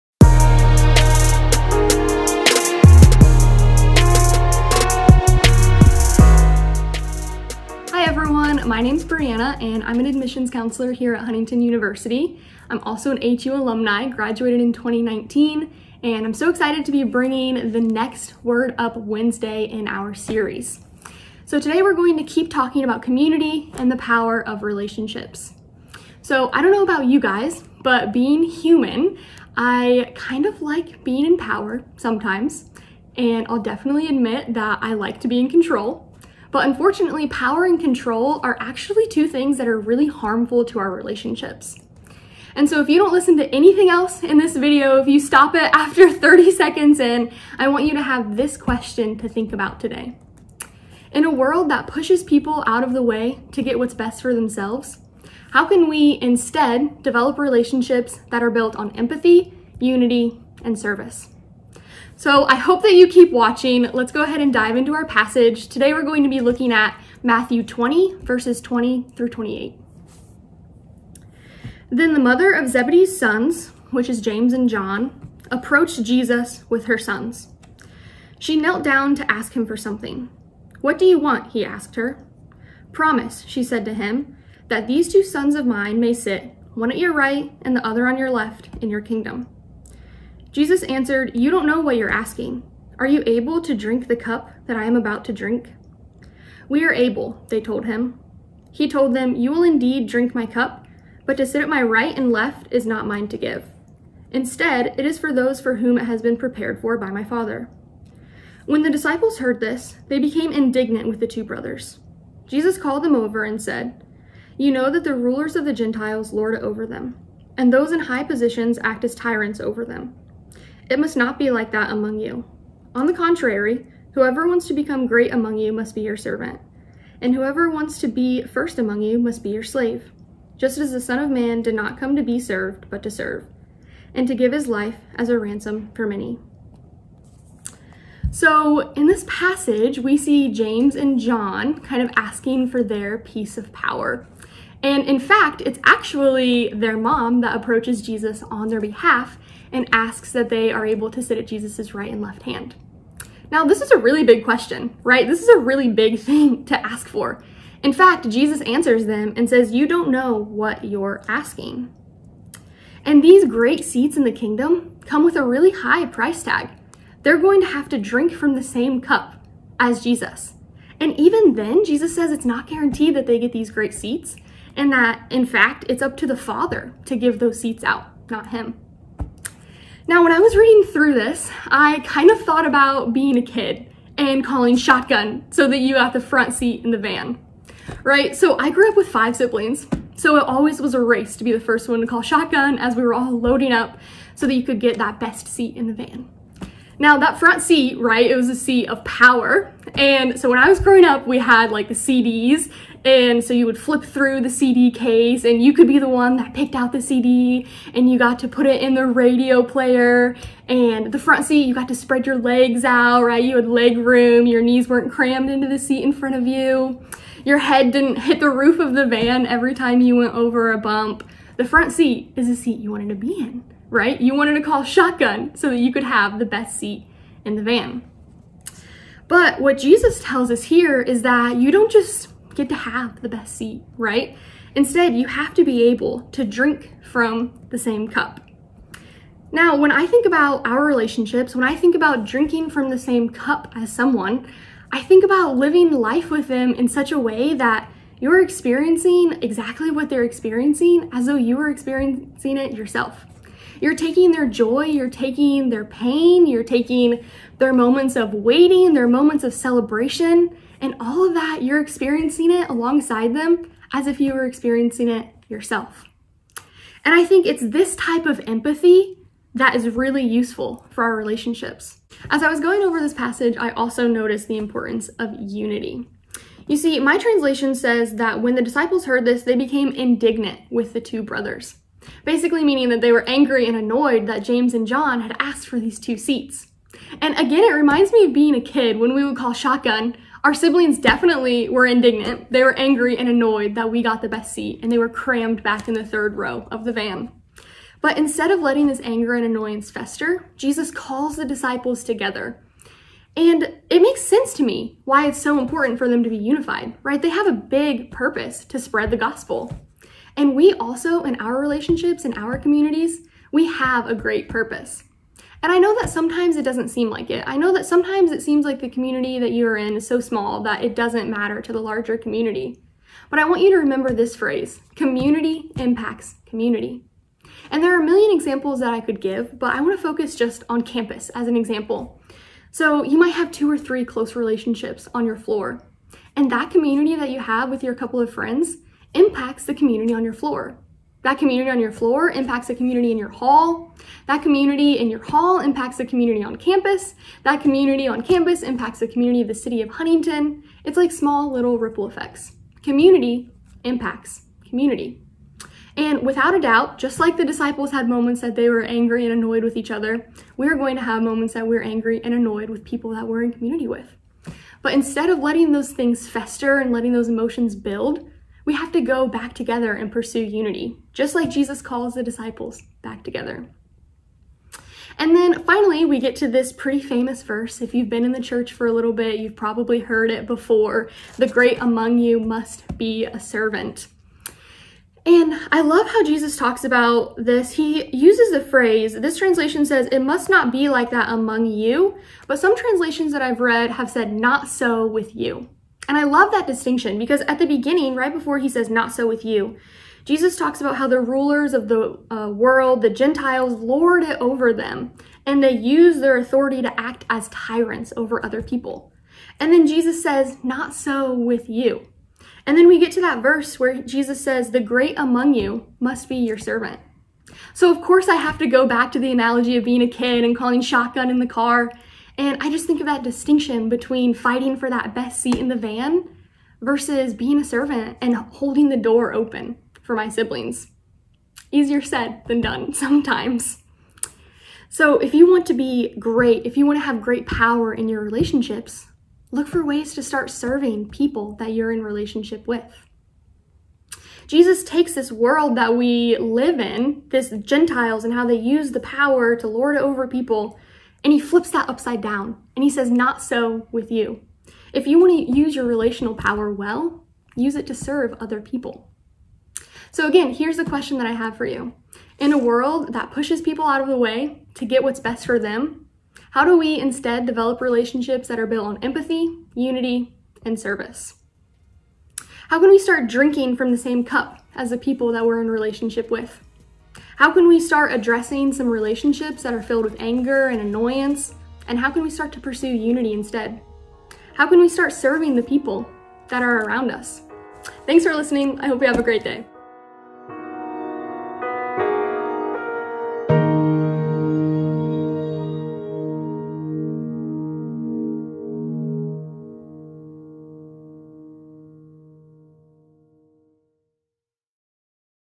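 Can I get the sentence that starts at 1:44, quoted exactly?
Instead, it is for those for whom it has been prepared for by my Father.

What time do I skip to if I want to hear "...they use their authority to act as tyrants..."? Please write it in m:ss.
6:45.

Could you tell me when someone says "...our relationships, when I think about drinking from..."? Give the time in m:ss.
4:00.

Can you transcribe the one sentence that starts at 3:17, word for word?
Now that front seat, right, it was a seat of power.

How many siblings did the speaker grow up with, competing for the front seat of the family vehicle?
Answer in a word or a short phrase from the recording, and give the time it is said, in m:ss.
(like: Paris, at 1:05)
5, at 3:09.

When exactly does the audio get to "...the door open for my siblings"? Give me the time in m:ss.
7:08.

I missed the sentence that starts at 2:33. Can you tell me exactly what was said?
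Now, this is a really big question, right?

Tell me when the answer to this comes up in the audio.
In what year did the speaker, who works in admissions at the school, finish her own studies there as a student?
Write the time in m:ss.
0:14.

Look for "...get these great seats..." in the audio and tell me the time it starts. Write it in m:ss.
2:53.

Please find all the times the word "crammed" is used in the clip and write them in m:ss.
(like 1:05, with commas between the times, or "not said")
3:35, 4:55.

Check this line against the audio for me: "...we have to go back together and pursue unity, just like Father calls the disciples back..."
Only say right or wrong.
wrong.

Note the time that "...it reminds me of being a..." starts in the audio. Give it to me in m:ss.
4:47.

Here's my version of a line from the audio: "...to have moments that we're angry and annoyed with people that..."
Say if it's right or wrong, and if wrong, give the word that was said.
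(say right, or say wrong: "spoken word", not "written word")
right.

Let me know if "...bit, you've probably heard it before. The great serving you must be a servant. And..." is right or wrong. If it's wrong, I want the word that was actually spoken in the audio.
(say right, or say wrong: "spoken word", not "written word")
wrong: "among", not "serving".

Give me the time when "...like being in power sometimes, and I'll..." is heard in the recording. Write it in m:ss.
0:30.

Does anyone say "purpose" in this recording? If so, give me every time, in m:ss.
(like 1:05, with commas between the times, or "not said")
5:08, 5:14.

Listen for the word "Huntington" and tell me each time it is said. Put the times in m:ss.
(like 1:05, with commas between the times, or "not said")
0:11, 5:49.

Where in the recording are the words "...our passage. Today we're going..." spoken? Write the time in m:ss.
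1:04.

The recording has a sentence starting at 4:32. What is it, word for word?
As I was going over this passage, I also noticed the importance of unity.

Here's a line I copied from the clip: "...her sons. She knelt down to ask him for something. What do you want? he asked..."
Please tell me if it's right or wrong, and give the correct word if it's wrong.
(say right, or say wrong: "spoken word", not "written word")
right.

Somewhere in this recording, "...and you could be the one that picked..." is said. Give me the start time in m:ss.
3:25.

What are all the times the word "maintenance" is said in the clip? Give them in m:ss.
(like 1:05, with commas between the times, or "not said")
not said.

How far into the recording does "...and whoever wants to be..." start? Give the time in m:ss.
2:07.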